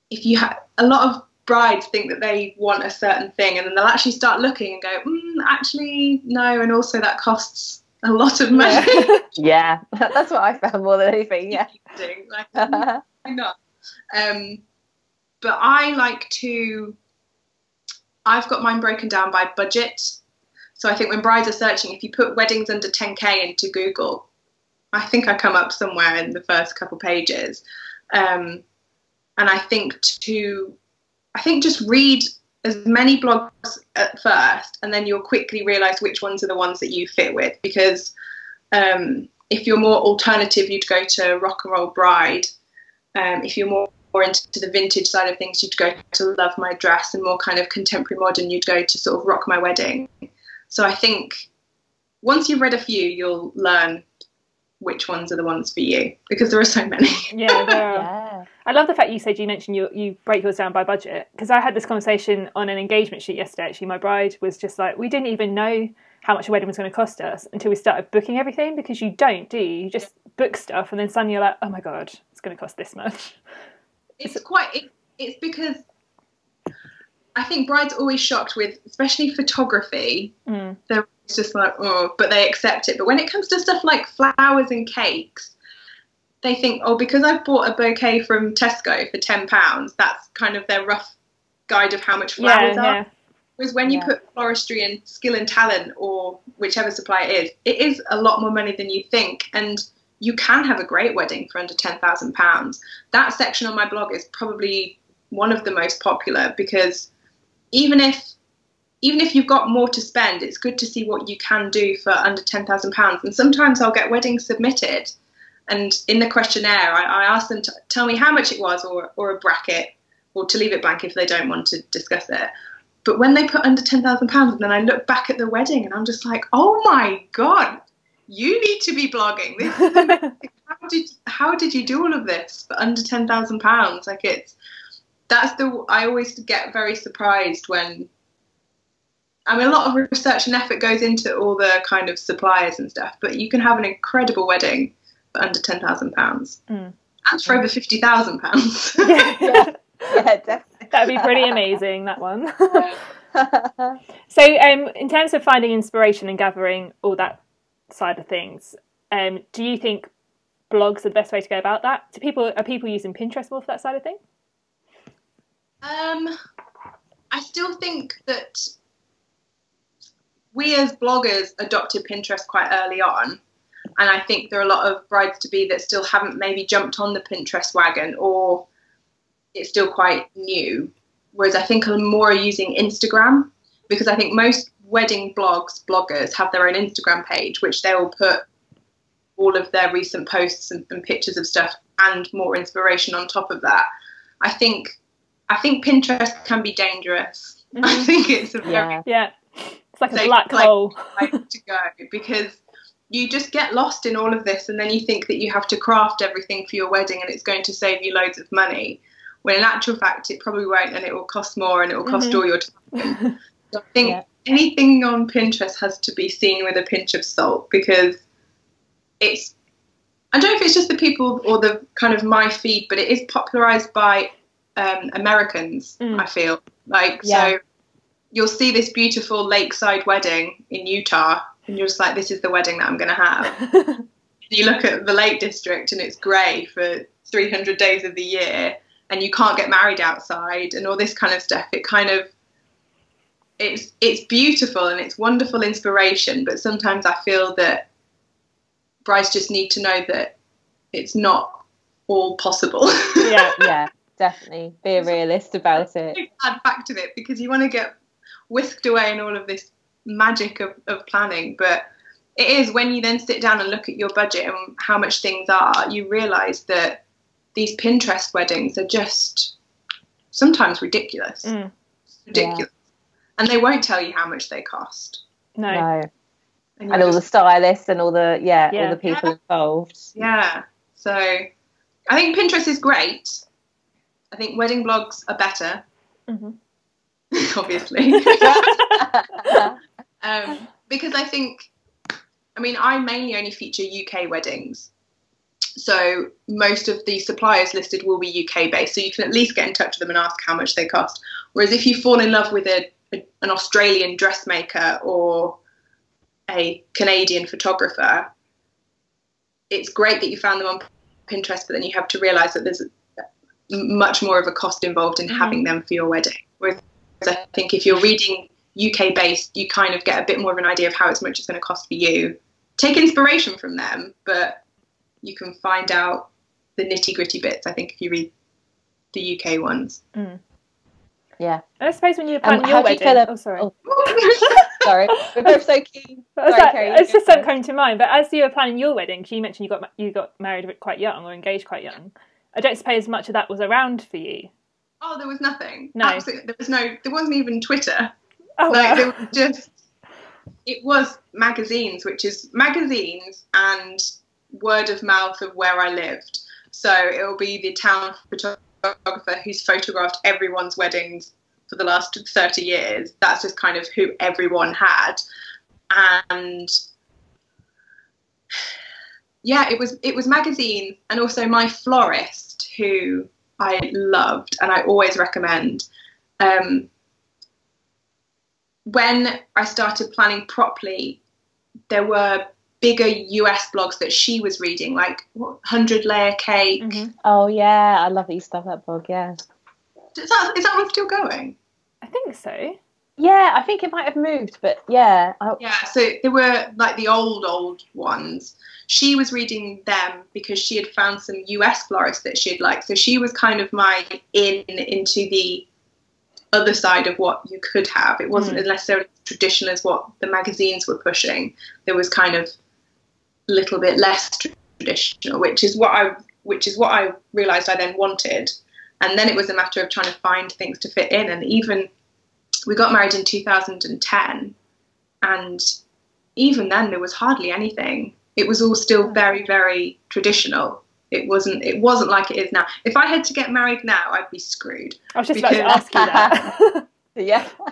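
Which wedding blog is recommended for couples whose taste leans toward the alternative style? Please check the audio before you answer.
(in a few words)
Rock and Roll Bride.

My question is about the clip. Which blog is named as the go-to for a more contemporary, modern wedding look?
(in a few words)
Rock My Wedding.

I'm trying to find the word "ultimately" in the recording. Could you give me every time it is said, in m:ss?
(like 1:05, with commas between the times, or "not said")
not said.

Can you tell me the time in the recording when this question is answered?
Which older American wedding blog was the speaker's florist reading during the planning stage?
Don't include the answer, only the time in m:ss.
6:25.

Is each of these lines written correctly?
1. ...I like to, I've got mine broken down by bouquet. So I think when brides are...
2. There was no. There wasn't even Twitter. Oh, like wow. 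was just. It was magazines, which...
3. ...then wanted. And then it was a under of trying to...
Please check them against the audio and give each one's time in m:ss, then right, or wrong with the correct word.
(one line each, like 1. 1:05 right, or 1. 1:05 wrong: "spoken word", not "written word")
1. 0:15 wrong: "budget", not "bouquet"
2. 5:46 right
3. 6:57 wrong: "matter", not "under".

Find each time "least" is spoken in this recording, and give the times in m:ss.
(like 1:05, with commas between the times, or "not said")
4:59.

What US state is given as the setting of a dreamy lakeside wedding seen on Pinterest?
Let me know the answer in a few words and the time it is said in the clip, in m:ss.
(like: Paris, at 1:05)
Utah, at 3:50.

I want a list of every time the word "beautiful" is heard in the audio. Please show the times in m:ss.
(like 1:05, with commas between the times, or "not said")
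3:48, 4:04.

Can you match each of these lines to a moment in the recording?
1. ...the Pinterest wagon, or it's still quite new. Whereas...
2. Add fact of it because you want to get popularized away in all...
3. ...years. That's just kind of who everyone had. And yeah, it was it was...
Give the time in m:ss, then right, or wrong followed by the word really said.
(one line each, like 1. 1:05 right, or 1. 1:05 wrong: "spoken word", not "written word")
1. 2:57 right
2. 4:16 wrong: "whisked", not "popularized"
3. 6:02 right.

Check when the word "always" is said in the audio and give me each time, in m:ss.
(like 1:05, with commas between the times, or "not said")
1:17, 2:16, 6:14.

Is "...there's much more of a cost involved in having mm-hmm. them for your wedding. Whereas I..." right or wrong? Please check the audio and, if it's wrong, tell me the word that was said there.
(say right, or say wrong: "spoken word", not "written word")
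right.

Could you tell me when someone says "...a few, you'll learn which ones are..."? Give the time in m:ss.
0:52.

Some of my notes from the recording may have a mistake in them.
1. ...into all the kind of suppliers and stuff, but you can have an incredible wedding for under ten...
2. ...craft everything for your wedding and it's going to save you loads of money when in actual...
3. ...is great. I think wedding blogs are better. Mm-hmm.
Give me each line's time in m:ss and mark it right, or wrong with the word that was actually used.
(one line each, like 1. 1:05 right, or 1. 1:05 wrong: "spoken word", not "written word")
1. 2:21 right
2. 3:25 right
3. 4:42 right.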